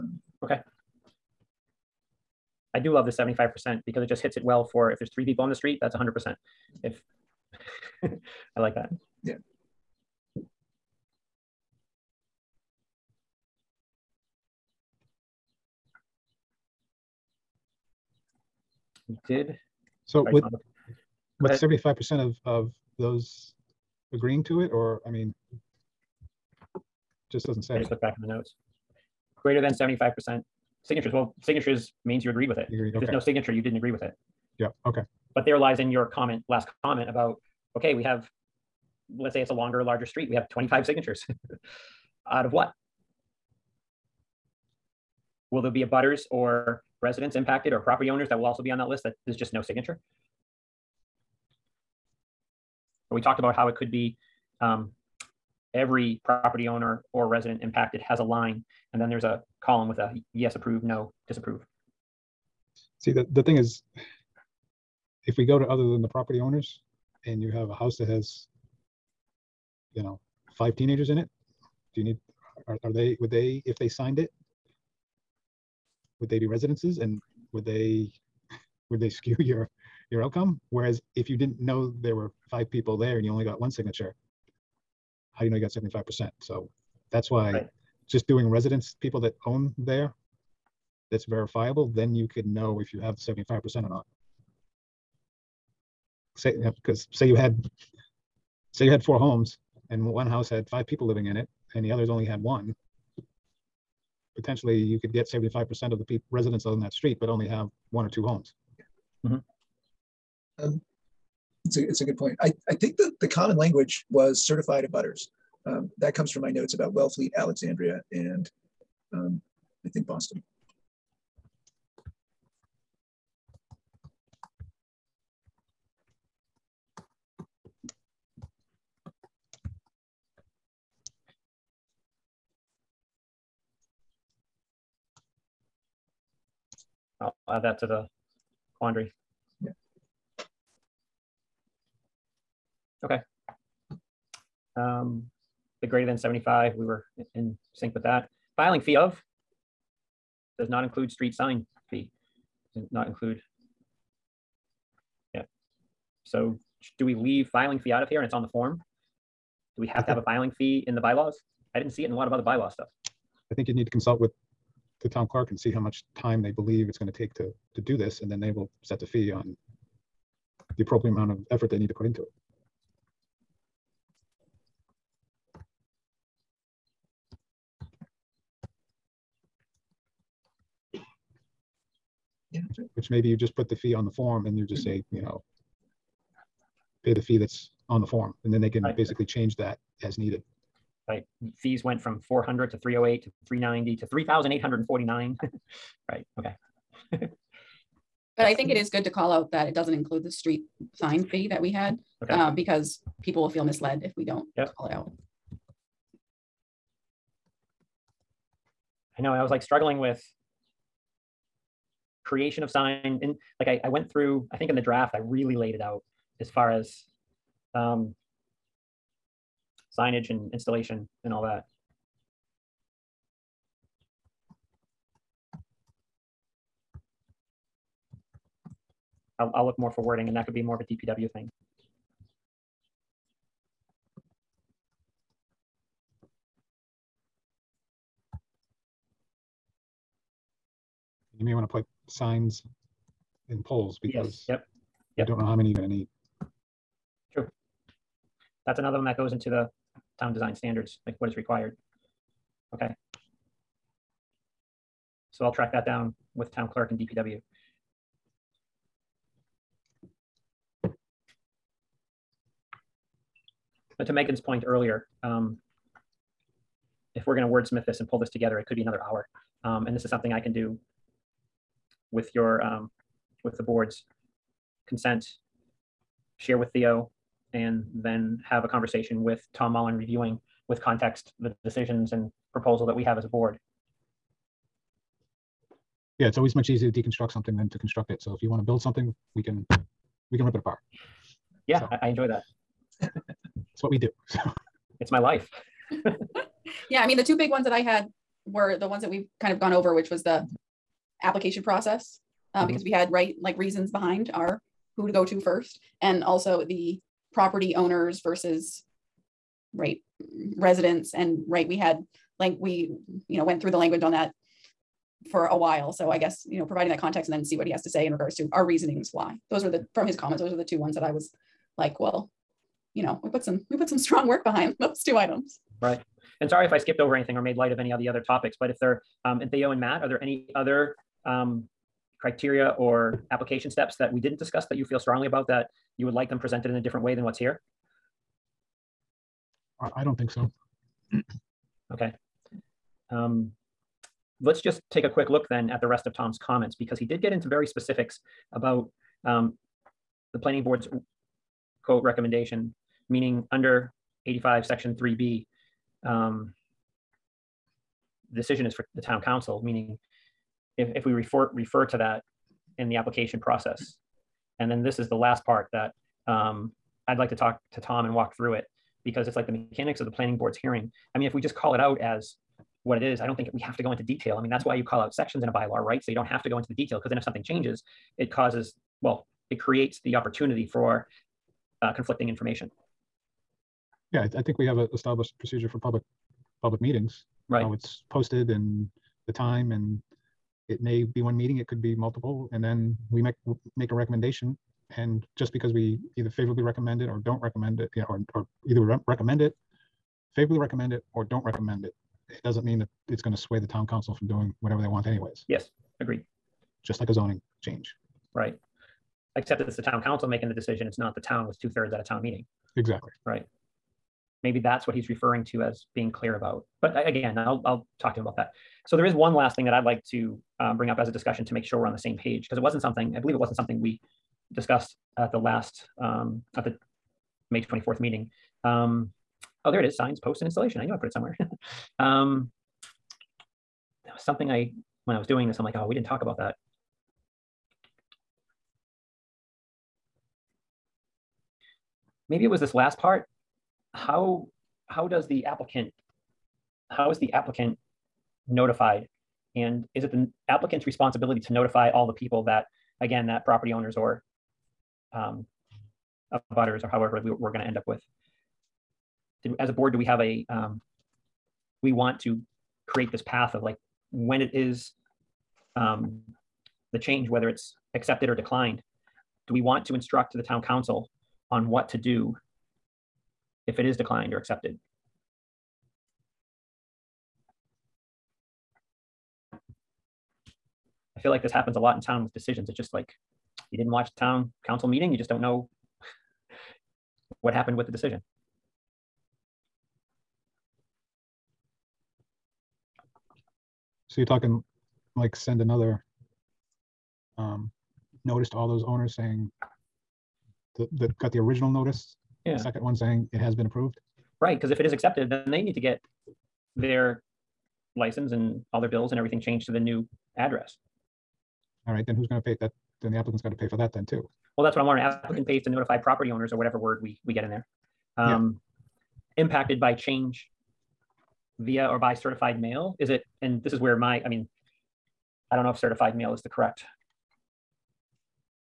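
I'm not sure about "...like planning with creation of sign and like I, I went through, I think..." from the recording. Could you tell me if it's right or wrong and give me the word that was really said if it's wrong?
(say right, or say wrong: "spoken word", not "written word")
wrong: "struggling", not "planning".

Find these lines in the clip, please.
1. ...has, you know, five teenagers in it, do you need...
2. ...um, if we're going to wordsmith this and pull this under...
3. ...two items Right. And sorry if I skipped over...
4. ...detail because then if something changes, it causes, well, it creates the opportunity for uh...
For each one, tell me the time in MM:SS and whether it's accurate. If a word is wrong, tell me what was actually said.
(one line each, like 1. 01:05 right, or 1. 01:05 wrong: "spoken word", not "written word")
1. 01:08 right
2. 04:25 wrong: "together", not "under"
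3. 05:25 right
4. 06:16 right.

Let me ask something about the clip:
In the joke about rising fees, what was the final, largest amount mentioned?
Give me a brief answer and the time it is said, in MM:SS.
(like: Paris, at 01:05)
3,849, at 03:14.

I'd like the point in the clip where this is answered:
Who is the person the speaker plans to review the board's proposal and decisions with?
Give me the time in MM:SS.
04:39.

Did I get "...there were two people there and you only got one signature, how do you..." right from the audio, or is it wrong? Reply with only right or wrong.
wrong.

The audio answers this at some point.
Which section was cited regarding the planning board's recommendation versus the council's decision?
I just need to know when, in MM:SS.
05:54.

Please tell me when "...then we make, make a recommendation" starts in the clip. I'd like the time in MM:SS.
06:32.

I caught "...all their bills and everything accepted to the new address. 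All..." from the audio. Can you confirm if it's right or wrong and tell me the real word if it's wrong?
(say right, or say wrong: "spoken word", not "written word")
wrong: "changed", not "accepted".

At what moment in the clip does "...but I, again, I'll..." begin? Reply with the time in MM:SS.
06:56.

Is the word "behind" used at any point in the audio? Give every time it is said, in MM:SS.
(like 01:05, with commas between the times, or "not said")
05:03, 05:24.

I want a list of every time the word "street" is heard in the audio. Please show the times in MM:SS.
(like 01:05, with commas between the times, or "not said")
00:05, 00:40, 01:46, 02:31, 03:20.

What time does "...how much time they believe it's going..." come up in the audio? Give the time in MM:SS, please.
02:45.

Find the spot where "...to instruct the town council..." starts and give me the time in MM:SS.
07:49.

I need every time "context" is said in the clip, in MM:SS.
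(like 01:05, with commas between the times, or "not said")
04:40, 05:16.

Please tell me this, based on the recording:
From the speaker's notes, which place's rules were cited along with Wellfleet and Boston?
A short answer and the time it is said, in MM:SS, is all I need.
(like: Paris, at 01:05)
Alexandria, at 01:57.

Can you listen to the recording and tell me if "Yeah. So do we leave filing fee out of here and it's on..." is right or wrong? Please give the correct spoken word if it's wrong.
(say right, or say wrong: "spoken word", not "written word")
right.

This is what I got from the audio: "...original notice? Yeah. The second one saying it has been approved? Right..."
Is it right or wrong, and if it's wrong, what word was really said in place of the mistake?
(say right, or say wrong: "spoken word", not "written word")
right.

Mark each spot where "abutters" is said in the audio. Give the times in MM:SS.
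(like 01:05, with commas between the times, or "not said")
00:45, 01:54, 07:36.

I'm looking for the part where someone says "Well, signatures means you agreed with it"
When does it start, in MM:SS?
00:31.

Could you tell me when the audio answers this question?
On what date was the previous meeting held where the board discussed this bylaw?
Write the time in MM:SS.
07:07.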